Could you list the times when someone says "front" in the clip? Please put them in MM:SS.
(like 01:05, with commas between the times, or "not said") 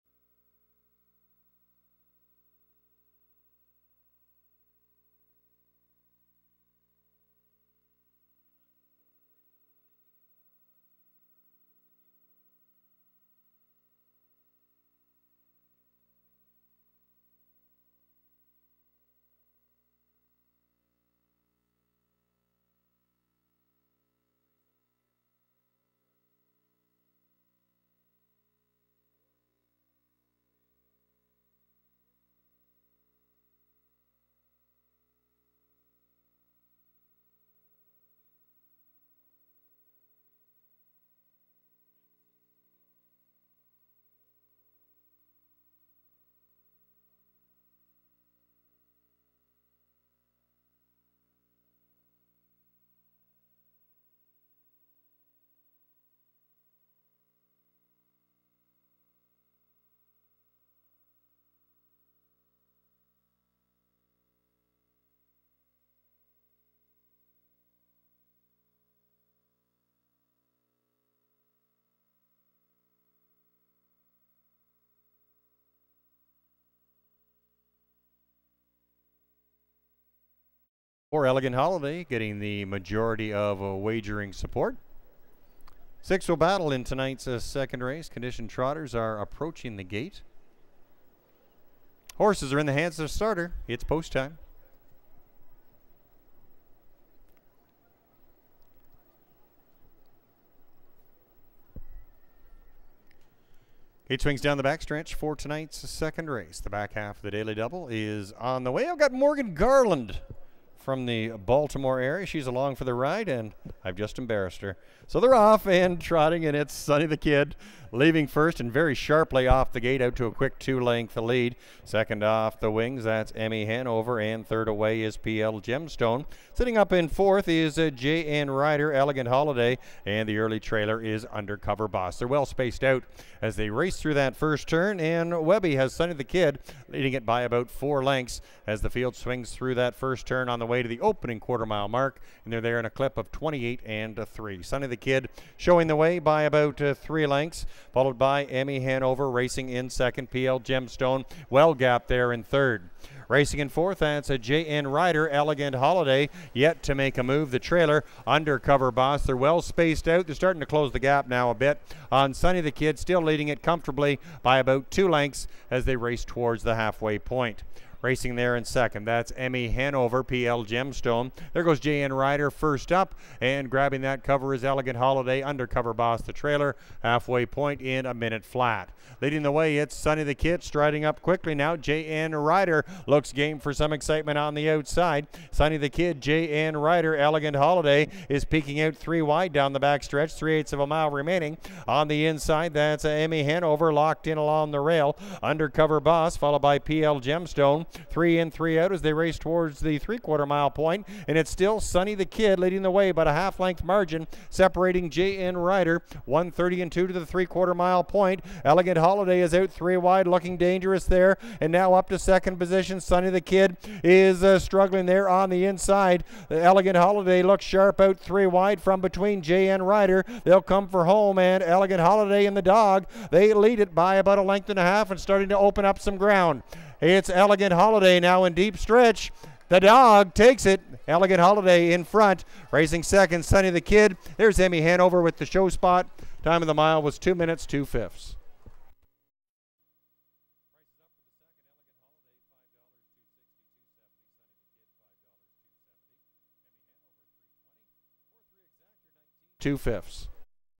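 03:52.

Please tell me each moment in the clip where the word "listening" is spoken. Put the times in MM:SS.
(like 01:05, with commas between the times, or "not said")
not said.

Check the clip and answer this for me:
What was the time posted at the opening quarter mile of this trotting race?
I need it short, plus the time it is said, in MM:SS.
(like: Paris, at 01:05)
28 and 3, at 02:23.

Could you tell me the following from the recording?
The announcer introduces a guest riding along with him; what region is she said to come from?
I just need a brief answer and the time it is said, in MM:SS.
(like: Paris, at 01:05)
Baltimore, at 01:51.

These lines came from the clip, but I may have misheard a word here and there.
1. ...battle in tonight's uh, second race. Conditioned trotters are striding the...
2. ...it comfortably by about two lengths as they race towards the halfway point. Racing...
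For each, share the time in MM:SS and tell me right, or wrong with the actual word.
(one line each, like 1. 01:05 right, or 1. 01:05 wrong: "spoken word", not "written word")
1. 01:26 wrong: "approaching", not "striding"
2. 02:43 right.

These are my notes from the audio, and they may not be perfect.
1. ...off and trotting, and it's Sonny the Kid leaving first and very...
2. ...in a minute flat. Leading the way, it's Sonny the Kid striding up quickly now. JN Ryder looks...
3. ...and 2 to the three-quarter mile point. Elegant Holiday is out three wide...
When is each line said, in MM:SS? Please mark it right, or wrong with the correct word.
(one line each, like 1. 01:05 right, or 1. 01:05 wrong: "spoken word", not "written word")
1. 01:55 right
2. 02:57 right
3. 03:26 right.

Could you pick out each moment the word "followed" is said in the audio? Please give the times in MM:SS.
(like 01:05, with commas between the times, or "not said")
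02:27, 03:16.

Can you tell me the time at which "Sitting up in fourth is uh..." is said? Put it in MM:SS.
02:06.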